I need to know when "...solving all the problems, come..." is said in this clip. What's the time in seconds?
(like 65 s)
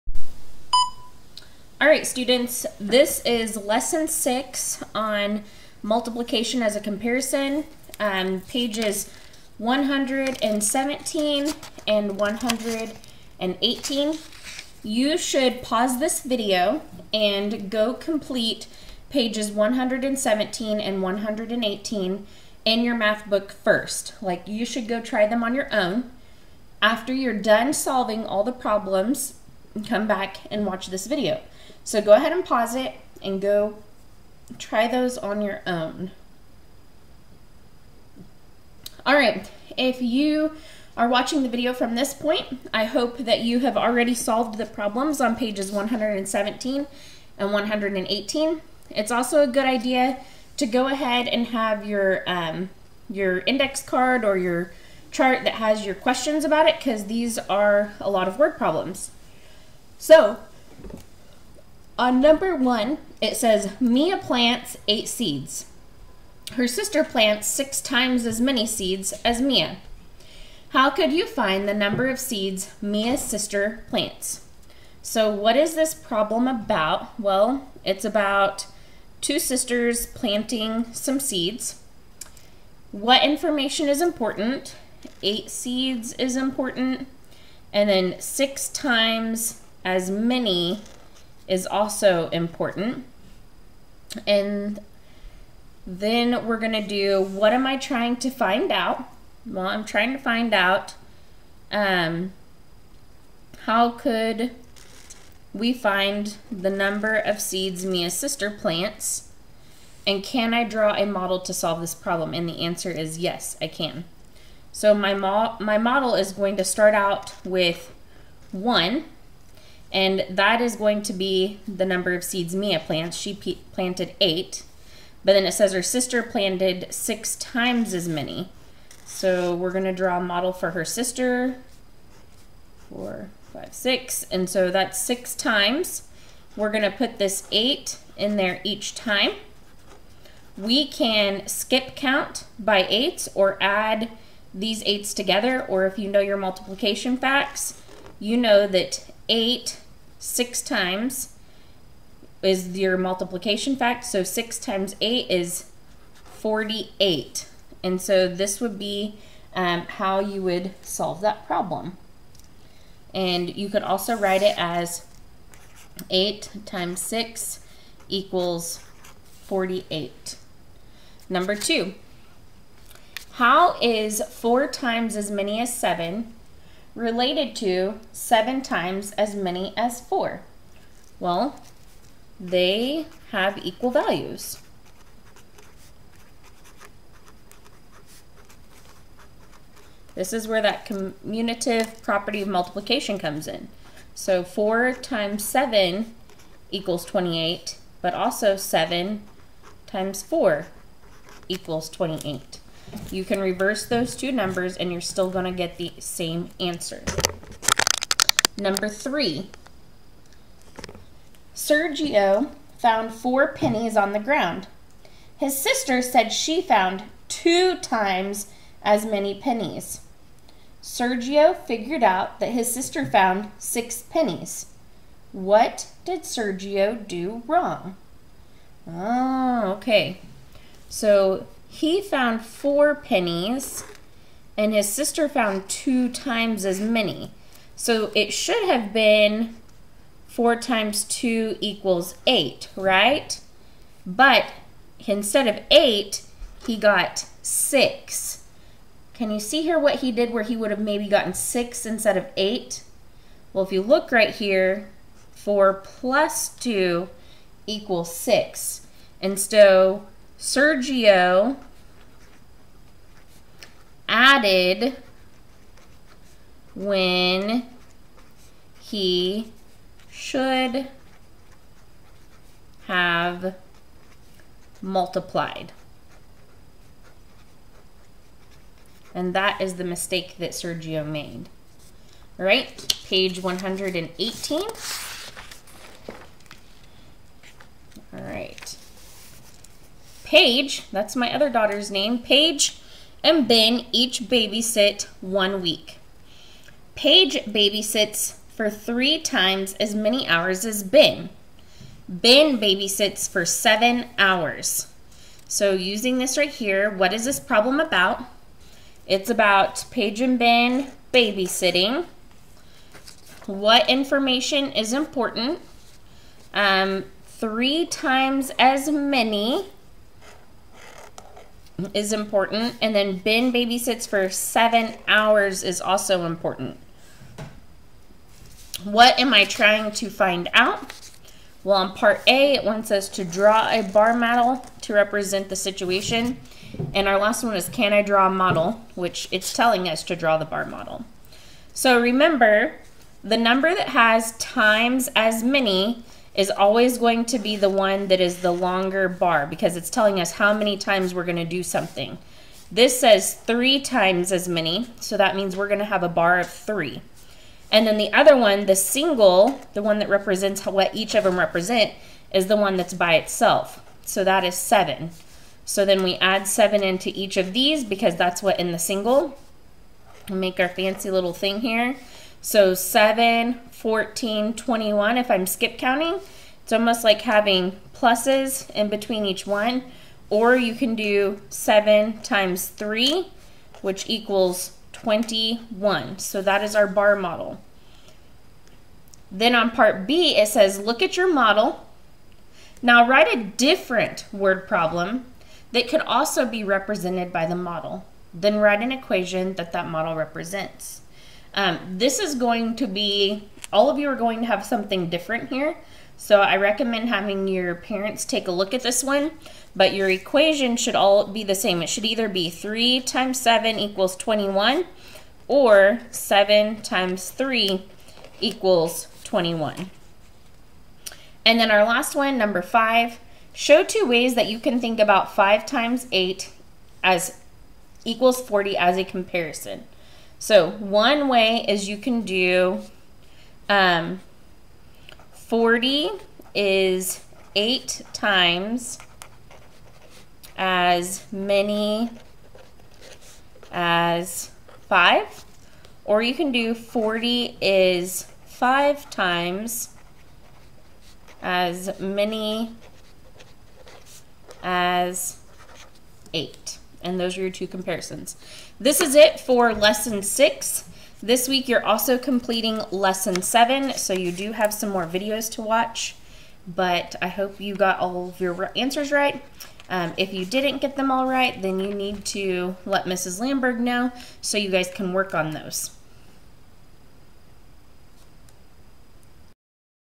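27 s.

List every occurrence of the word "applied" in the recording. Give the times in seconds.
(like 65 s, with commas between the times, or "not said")
not said.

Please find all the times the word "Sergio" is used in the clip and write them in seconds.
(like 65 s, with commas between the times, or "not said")
211 s, 220 s, 226 s, 260 s, 280 s.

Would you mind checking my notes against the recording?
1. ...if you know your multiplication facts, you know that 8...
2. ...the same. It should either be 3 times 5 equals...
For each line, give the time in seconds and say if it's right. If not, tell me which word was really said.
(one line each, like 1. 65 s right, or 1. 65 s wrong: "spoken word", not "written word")
1. 145 s right
2. 411 s wrong: "7", not "5".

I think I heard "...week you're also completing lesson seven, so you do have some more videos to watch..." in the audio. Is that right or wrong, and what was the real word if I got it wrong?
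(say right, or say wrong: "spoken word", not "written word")
right.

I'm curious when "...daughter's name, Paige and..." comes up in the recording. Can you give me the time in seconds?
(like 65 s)
291 s.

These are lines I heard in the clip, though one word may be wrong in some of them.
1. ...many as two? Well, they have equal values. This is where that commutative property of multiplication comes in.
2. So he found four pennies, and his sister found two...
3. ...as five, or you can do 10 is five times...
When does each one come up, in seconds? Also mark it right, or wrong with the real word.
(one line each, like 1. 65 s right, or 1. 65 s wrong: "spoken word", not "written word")
1. 179 s wrong: "four", not "two"
2. 230 s right
3. 443 s wrong: "40", not "10".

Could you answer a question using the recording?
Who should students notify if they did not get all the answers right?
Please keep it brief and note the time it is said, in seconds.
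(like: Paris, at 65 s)
Mrs. Landburg, at 473 s.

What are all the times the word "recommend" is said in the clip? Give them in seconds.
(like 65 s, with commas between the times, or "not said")
406 s.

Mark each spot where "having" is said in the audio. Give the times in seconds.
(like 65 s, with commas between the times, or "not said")
377 s, 407 s.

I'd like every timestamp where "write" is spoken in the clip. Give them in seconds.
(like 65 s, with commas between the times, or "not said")
164 s, 393 s, 398 s.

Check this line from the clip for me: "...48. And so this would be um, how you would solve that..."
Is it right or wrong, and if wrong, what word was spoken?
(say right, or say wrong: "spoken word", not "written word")
right.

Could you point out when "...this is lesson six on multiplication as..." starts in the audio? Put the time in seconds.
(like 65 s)
2 s.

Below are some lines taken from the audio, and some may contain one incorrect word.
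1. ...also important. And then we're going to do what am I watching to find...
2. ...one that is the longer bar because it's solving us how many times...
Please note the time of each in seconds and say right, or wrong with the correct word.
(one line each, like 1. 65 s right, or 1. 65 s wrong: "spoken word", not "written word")
1. 91 s wrong: "trying", not "watching"
2. 347 s wrong: "telling", not "solving".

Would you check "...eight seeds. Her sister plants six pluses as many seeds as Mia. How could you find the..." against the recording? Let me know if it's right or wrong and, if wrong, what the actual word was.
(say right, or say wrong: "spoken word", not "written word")
wrong: "times", not "pluses".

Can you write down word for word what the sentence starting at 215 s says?
His sister said she found two times as many pennies.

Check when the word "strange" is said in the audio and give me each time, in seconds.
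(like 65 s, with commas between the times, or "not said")
not said.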